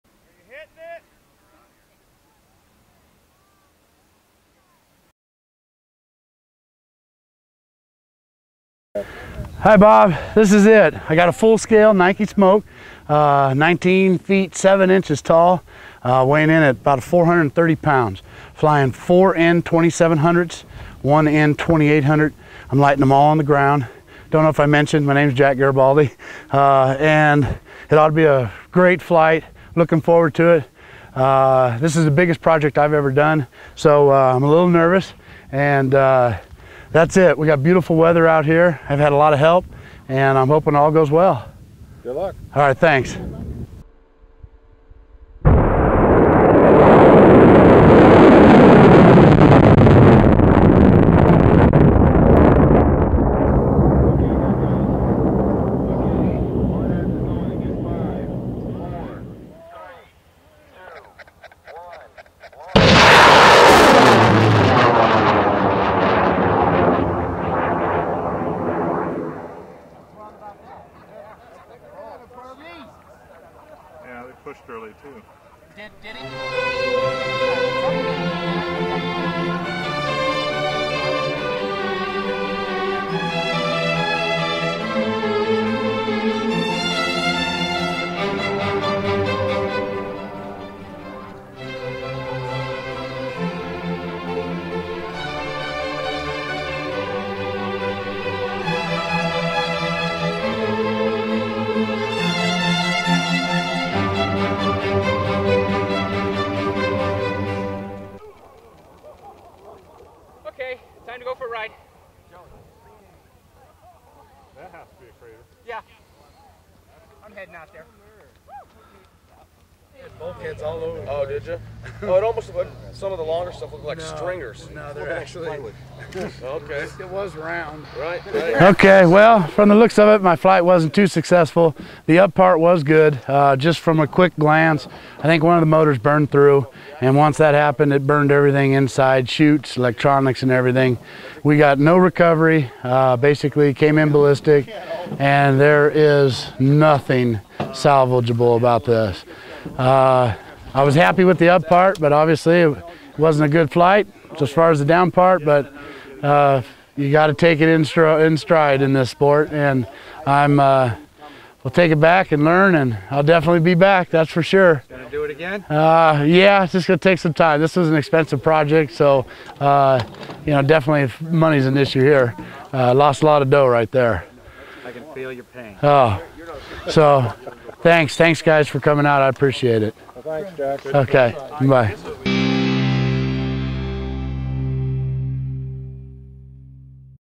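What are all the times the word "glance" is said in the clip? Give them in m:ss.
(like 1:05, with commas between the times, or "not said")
2:14.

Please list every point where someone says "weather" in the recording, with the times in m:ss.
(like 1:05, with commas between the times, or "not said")
0:37.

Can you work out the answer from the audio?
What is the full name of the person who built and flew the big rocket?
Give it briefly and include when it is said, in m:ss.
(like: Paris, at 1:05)
Jack Garibaldi, at 0:25.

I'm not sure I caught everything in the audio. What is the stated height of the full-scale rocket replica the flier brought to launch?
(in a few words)
19 feet 7 inches.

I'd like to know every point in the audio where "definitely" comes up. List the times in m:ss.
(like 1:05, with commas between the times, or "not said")
2:43, 2:50.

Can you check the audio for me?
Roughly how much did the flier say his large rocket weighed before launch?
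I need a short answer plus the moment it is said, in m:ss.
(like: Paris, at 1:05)
430 pounds, at 0:17.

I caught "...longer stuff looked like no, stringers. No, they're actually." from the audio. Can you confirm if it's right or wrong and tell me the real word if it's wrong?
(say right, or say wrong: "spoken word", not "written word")
right.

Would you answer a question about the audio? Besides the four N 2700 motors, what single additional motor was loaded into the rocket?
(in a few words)
N 2800.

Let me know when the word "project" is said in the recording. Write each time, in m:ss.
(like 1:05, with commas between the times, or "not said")
0:32, 2:48.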